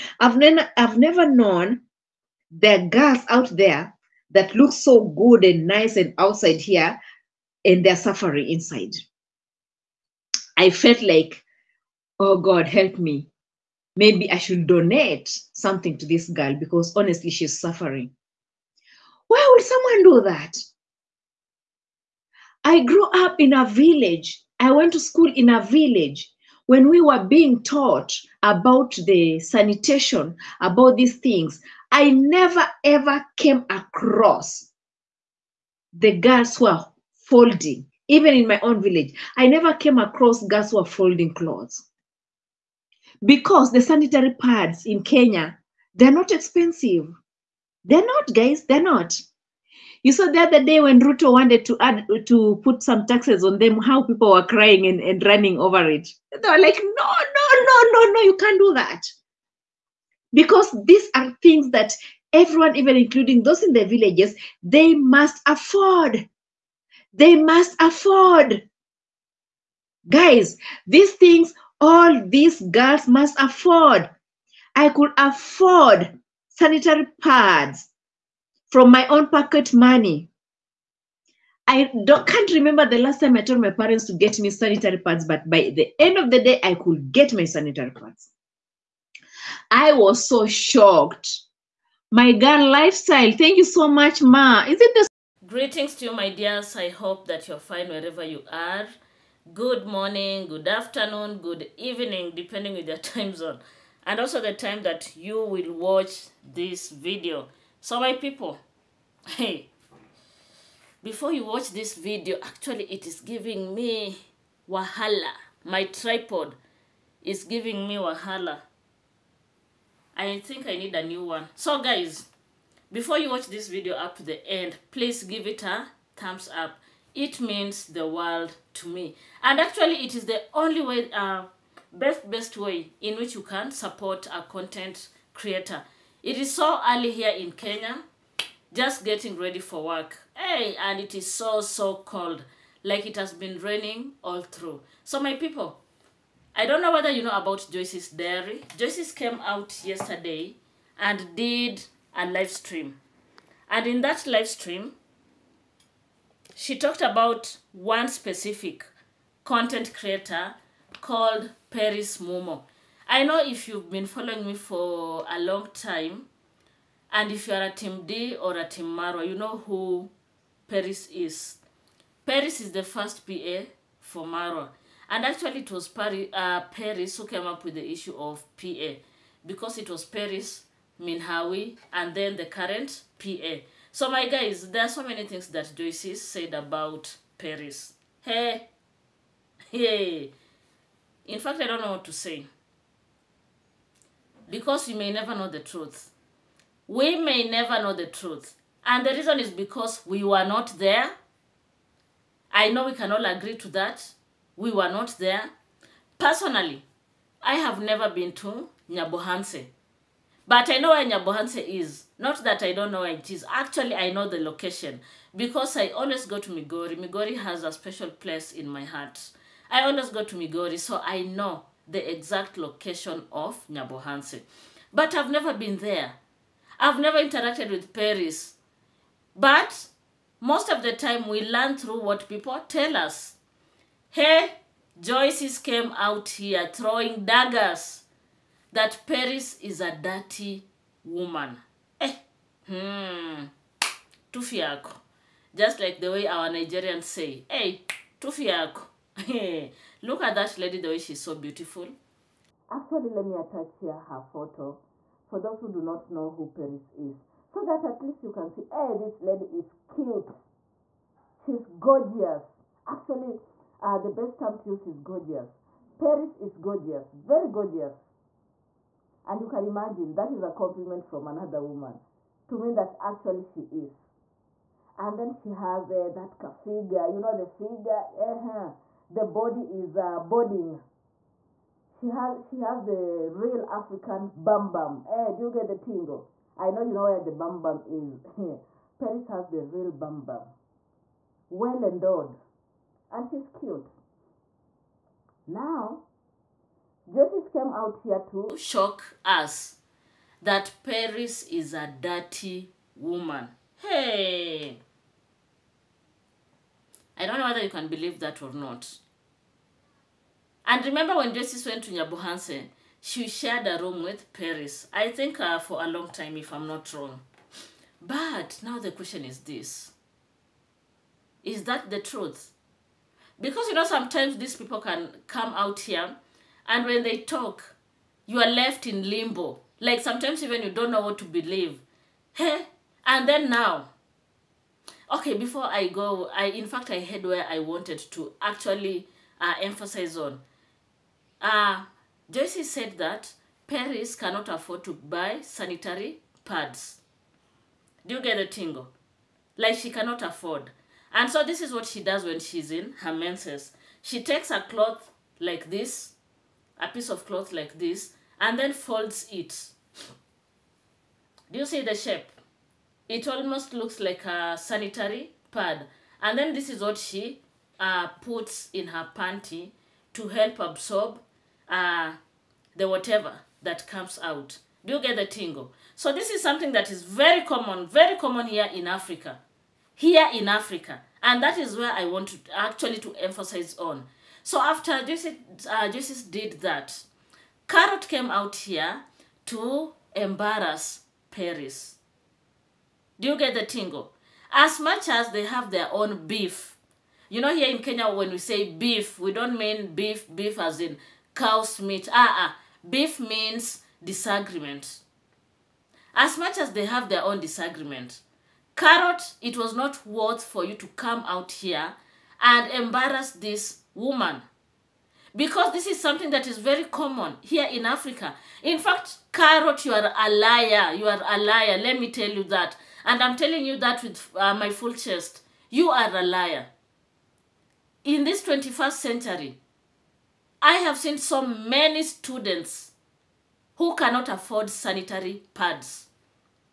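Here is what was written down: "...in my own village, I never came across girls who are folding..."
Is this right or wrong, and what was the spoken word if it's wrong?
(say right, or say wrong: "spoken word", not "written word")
right.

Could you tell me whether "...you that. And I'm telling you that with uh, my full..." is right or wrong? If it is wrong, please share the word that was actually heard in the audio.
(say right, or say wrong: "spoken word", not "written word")
right.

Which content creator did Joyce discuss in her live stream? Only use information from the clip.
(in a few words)
Peris Mumo.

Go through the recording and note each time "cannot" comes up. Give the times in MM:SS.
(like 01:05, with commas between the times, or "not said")
05:44, 05:49, 07:13.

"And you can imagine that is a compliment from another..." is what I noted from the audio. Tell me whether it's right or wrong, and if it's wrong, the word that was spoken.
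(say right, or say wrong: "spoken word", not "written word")
right.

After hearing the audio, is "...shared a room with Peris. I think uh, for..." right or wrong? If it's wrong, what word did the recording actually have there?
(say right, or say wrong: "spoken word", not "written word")
right.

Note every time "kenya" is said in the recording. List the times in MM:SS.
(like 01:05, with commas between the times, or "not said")
00:45, 02:17, 06:37.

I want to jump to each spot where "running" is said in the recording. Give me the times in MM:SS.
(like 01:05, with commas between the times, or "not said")
00:55.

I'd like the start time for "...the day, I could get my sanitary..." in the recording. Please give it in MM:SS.
01:26.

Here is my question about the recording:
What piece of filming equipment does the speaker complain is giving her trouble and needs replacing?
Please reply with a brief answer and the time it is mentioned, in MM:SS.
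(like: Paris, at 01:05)
tripod, at 01:55.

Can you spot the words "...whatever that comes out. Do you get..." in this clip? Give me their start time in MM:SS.
06:12.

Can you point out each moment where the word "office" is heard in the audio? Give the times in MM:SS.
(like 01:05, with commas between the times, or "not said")
not said.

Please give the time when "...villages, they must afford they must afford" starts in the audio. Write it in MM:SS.
01:03.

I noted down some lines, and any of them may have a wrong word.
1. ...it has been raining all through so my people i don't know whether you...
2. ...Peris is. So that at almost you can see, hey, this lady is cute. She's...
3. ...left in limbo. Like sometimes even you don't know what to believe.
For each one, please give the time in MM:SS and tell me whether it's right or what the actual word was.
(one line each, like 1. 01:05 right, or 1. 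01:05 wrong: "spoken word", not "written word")
1. 02:23 right
2. 04:16 wrong: "least", not "almost"
3. 05:28 right.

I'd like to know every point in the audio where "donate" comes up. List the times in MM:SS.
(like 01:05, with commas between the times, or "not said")
00:14.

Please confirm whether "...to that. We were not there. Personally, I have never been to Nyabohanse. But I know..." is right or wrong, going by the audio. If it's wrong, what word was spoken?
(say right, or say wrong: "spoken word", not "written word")
right.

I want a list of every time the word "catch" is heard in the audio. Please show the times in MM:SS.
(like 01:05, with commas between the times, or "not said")
not said.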